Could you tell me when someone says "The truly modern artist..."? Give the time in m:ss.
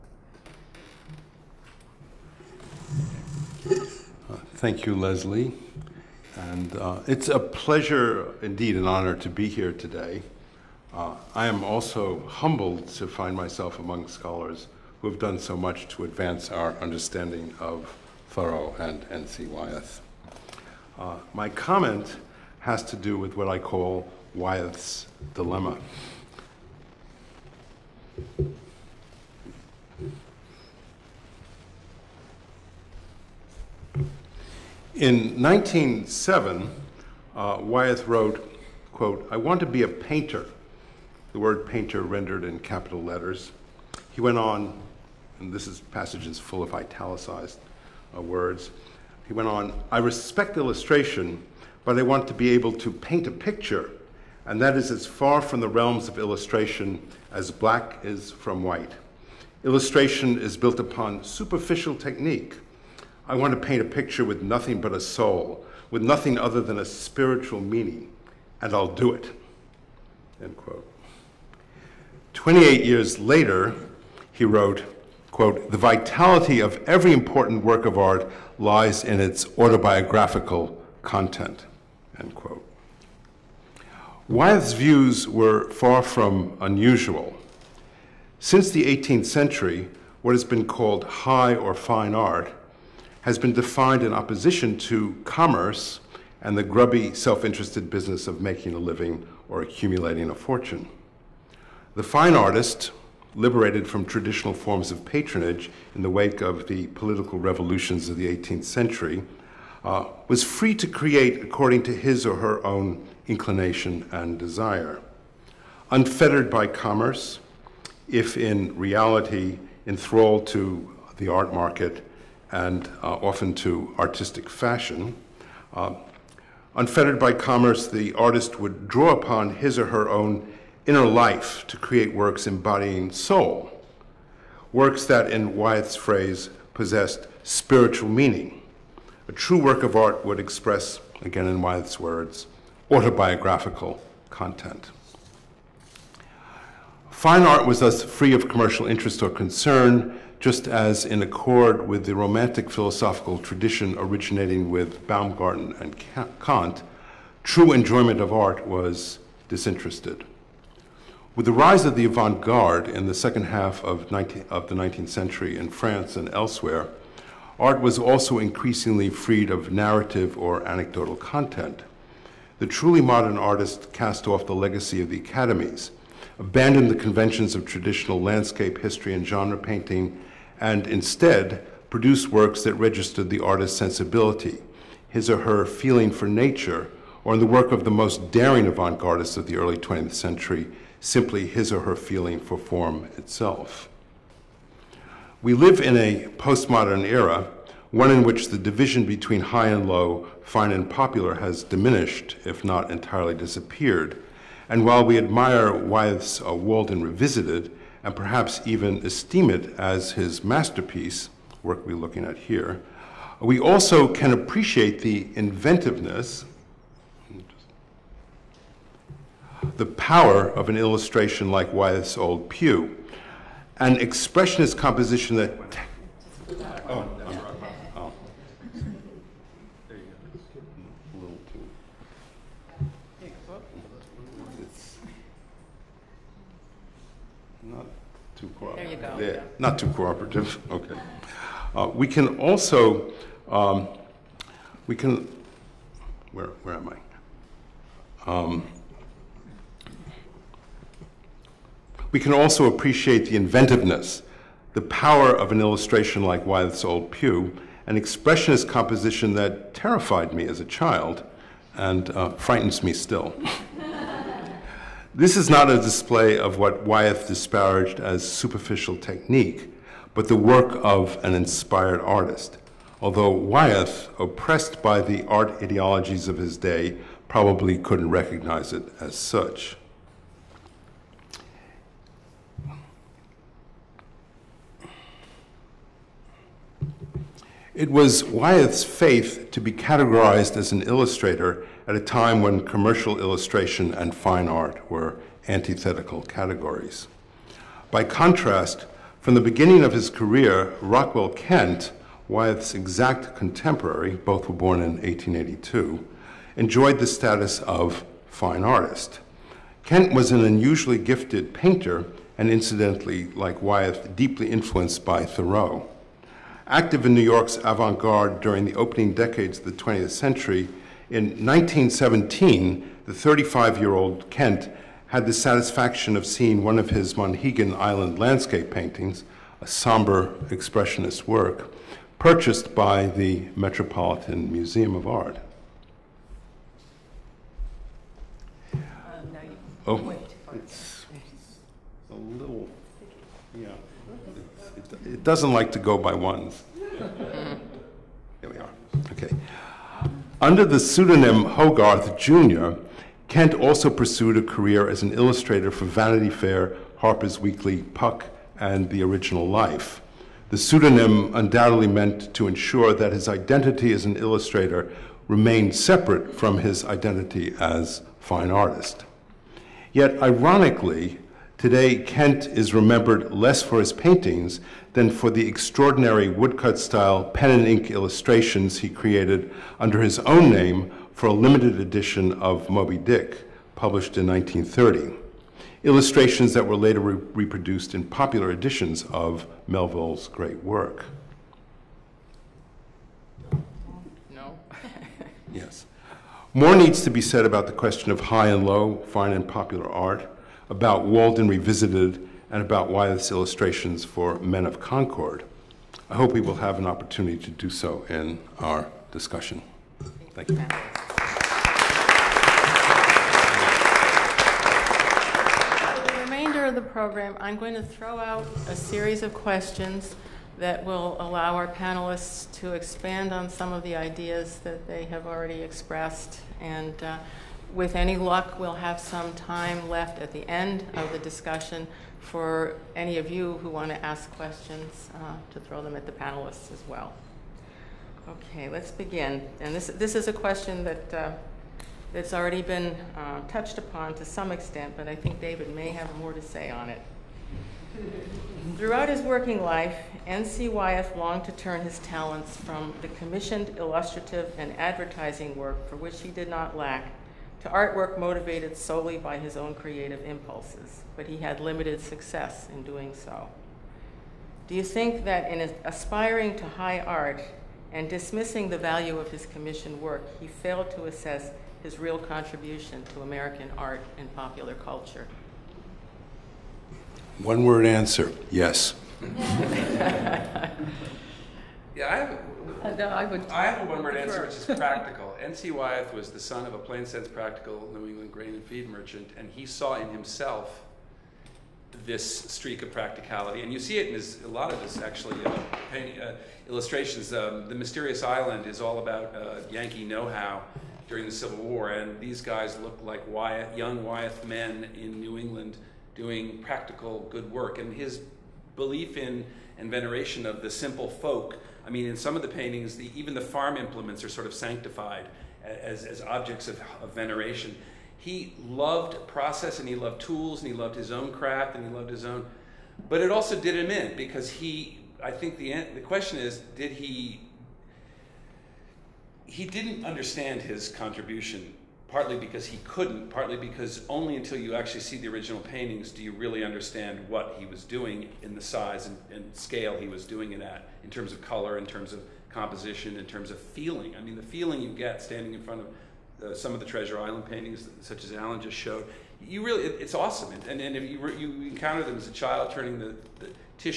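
2:52.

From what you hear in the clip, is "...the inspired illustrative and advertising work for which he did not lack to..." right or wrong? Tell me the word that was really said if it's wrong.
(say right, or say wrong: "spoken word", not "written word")
wrong: "commissioned", not "inspired".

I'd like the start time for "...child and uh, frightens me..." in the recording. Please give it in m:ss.
4:20.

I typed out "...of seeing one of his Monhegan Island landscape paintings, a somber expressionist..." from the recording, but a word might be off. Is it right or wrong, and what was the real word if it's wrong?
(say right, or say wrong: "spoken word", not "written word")
right.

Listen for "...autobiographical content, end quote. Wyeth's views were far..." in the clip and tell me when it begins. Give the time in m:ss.
1:19.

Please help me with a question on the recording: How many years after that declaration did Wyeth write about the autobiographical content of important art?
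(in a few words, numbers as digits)
28.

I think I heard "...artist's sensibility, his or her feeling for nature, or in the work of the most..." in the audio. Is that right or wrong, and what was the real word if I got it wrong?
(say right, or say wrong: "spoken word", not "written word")
right.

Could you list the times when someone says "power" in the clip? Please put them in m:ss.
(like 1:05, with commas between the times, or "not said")
3:39, 4:14.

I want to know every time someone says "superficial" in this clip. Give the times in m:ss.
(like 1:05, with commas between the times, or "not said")
1:01, 4:28.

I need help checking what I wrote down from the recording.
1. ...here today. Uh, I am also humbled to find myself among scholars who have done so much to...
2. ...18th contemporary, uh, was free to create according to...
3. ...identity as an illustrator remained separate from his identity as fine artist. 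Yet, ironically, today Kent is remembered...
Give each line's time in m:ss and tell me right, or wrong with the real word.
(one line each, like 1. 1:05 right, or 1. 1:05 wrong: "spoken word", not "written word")
1. 0:09 right
2. 1:48 wrong: "century", not "contemporary"
3. 6:03 right.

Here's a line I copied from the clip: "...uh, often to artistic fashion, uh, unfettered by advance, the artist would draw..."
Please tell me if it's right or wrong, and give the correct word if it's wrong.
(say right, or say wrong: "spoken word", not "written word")
wrong: "commerce", not "advance".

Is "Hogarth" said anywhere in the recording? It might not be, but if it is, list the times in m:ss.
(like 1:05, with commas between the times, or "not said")
5:51.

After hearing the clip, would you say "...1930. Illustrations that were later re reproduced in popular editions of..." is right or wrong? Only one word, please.
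right.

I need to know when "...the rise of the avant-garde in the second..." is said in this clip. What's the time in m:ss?
2:41.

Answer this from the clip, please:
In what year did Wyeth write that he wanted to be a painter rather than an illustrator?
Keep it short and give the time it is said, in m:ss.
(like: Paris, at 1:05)
1907, at 0:35.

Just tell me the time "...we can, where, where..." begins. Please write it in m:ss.
4:04.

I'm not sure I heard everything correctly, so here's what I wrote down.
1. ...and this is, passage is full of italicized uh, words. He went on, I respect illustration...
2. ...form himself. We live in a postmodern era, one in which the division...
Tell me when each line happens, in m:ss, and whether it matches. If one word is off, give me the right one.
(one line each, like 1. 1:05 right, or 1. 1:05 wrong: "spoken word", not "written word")
1. 0:45 right
2. 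3:12 wrong: "itself", not "himself".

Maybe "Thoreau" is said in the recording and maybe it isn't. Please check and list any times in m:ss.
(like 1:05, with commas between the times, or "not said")
0:18, 5:15.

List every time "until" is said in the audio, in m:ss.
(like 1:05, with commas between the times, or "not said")
8:54.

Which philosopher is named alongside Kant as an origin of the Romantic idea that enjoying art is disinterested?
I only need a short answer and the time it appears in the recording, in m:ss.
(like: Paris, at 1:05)
Baumgarten, at 2:35.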